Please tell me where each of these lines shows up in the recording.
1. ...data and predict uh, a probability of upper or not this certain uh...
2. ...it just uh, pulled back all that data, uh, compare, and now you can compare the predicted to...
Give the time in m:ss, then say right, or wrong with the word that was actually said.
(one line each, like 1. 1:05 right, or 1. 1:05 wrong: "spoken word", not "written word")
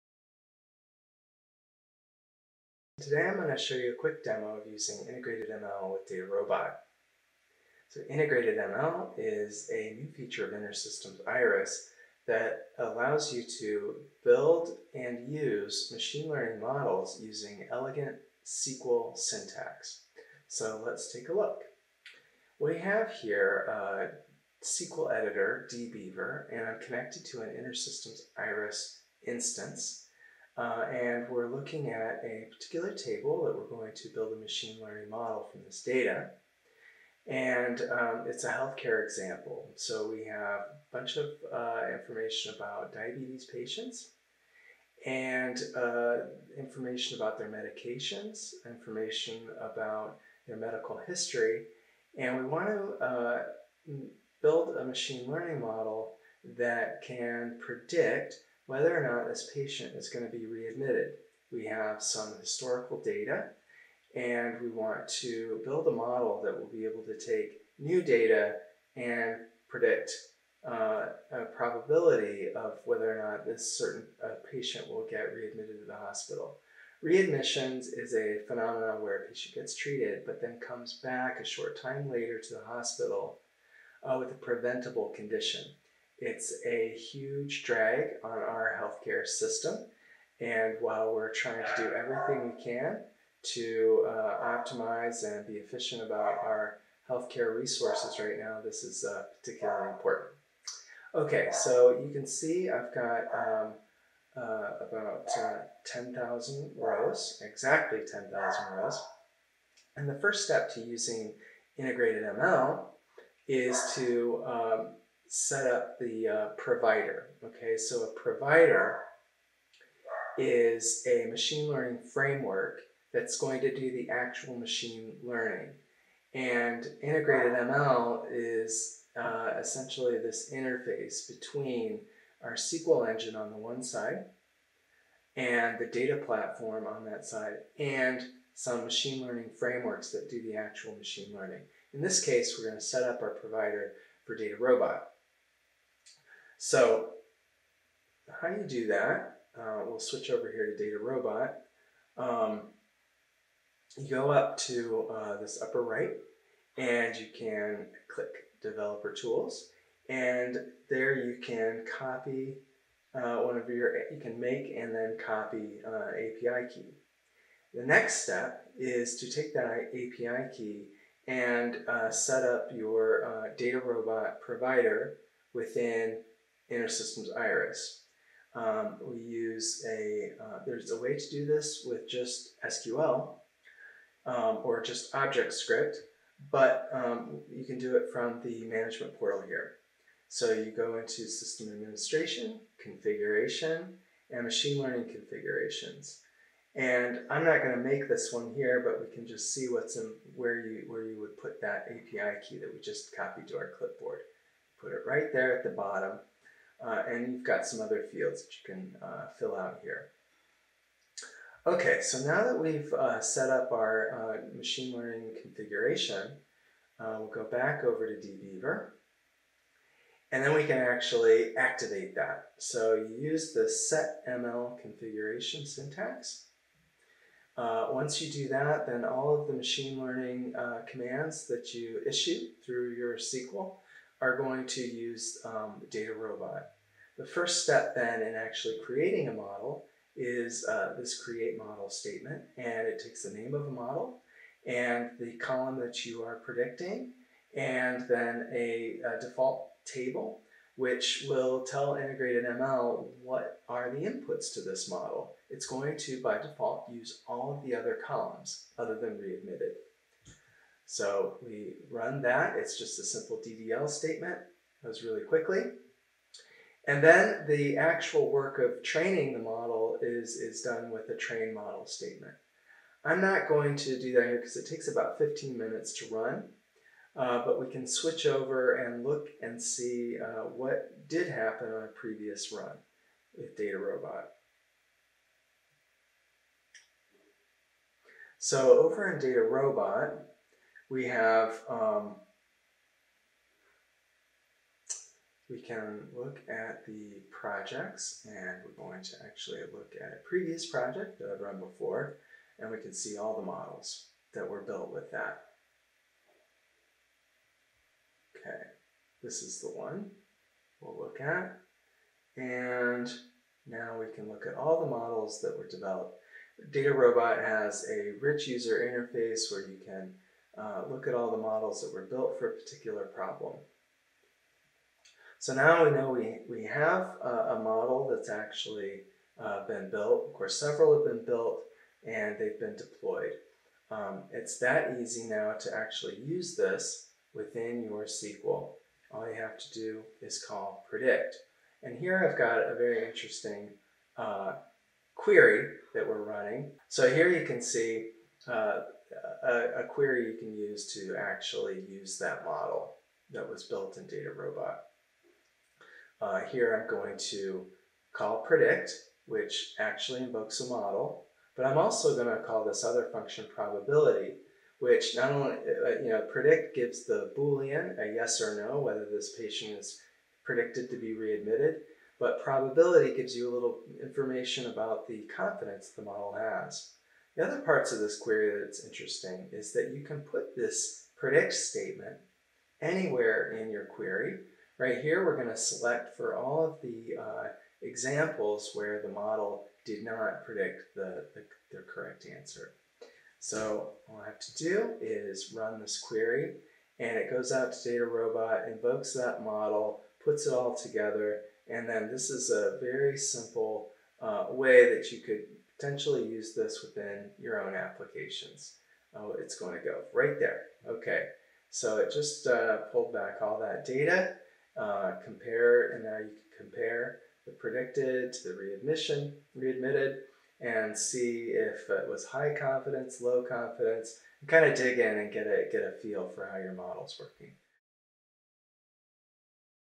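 1. 1:08 wrong: "whether", not "upper"
2. 6:51 right.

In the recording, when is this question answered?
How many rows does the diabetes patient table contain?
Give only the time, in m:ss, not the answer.
1:47.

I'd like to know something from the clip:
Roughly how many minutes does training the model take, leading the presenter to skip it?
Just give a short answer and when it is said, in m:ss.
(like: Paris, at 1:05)
15, at 4:35.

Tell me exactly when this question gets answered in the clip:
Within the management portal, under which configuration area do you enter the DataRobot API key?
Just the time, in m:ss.
3:14.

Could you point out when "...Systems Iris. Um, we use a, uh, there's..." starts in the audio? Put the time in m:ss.
2:56.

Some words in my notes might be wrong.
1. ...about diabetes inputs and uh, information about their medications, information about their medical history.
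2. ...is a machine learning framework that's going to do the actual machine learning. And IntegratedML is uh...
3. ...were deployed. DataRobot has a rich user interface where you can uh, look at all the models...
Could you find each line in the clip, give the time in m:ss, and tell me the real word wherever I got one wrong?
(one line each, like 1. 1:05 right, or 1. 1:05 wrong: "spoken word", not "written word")
1. 0:42 wrong: "patients", not "inputs"
2. 2:00 right
3. 5:15 wrong: "developed", not "deployed".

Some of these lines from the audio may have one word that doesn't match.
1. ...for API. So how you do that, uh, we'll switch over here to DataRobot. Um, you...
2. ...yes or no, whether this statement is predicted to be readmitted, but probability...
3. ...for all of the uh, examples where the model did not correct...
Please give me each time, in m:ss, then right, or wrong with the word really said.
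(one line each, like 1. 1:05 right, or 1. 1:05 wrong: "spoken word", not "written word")
1. 2:24 wrong: "DataRobot", not "API"
2. 6:08 wrong: "patient", not "statement"
3. 6:26 wrong: "predict", not "correct".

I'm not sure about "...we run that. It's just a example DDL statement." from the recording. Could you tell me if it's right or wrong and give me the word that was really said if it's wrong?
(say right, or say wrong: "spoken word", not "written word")
wrong: "simple", not "example".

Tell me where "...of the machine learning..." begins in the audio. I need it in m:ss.
3:49.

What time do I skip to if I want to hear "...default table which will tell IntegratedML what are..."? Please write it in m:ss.
4:09.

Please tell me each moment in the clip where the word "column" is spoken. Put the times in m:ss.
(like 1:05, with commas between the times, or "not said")
4:05, 4:18.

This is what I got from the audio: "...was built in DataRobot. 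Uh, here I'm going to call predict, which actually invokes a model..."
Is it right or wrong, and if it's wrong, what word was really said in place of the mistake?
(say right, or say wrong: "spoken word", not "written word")
right.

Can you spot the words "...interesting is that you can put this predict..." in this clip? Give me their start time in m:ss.
6:18.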